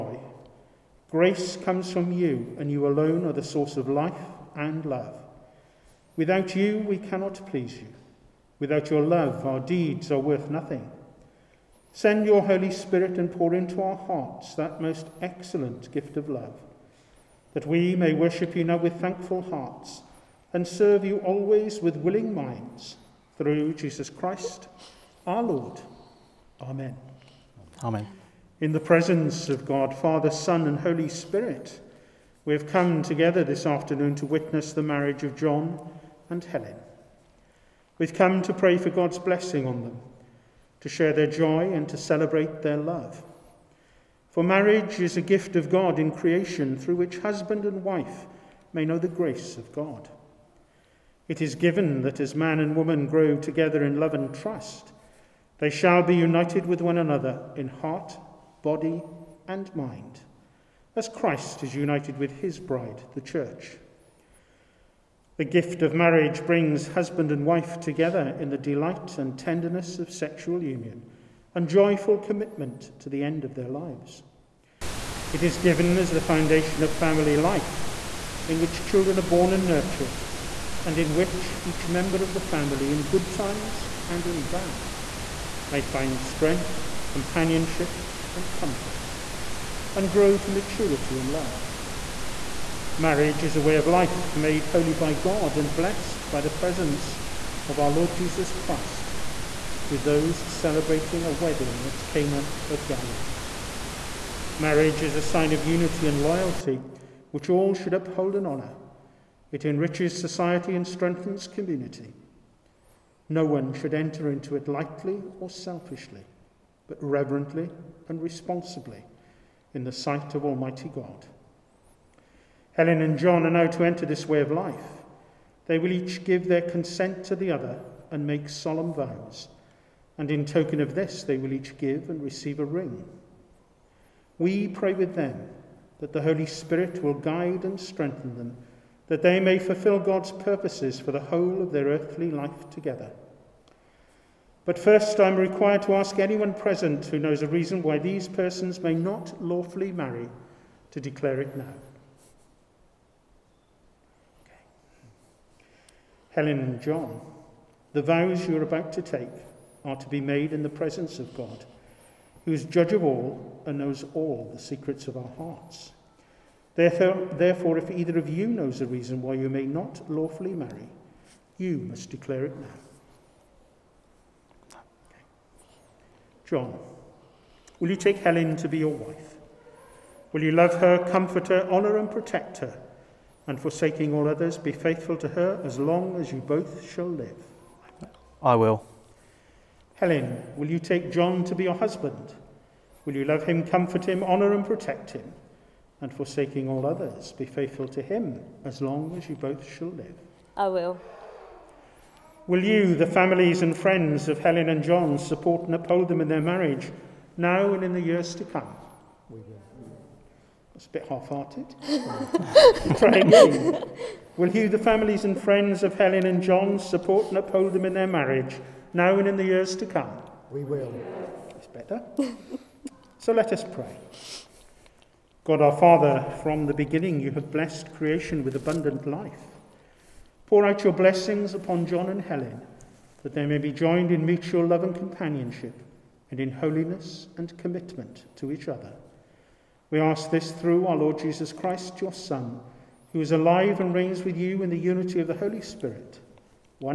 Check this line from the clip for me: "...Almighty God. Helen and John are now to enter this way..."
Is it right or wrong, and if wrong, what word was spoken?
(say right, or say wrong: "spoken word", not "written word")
right.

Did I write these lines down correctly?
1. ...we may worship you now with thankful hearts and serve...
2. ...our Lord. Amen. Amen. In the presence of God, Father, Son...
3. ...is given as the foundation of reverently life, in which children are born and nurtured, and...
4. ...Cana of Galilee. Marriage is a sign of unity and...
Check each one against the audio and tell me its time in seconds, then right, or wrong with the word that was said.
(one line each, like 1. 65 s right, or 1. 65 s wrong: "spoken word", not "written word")
1. 17 s right
2. 25 s right
3. 75 s wrong: "family", not "reverently"
4. 102 s right.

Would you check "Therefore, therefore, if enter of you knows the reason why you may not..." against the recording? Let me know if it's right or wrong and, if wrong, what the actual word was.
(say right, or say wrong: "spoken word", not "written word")
wrong: "either", not "enter".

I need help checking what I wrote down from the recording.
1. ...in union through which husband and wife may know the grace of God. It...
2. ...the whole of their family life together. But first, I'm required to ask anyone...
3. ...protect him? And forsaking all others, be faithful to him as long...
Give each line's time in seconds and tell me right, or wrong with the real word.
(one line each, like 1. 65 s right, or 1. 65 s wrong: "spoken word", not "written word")
1. 45 s wrong: "creation", not "union"
2. 141 s wrong: "earthly", not "family"
3. 194 s right.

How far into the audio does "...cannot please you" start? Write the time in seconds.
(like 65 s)
6 s.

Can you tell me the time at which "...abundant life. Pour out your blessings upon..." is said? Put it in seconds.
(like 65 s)
228 s.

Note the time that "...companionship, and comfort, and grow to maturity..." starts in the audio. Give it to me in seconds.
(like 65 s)
87 s.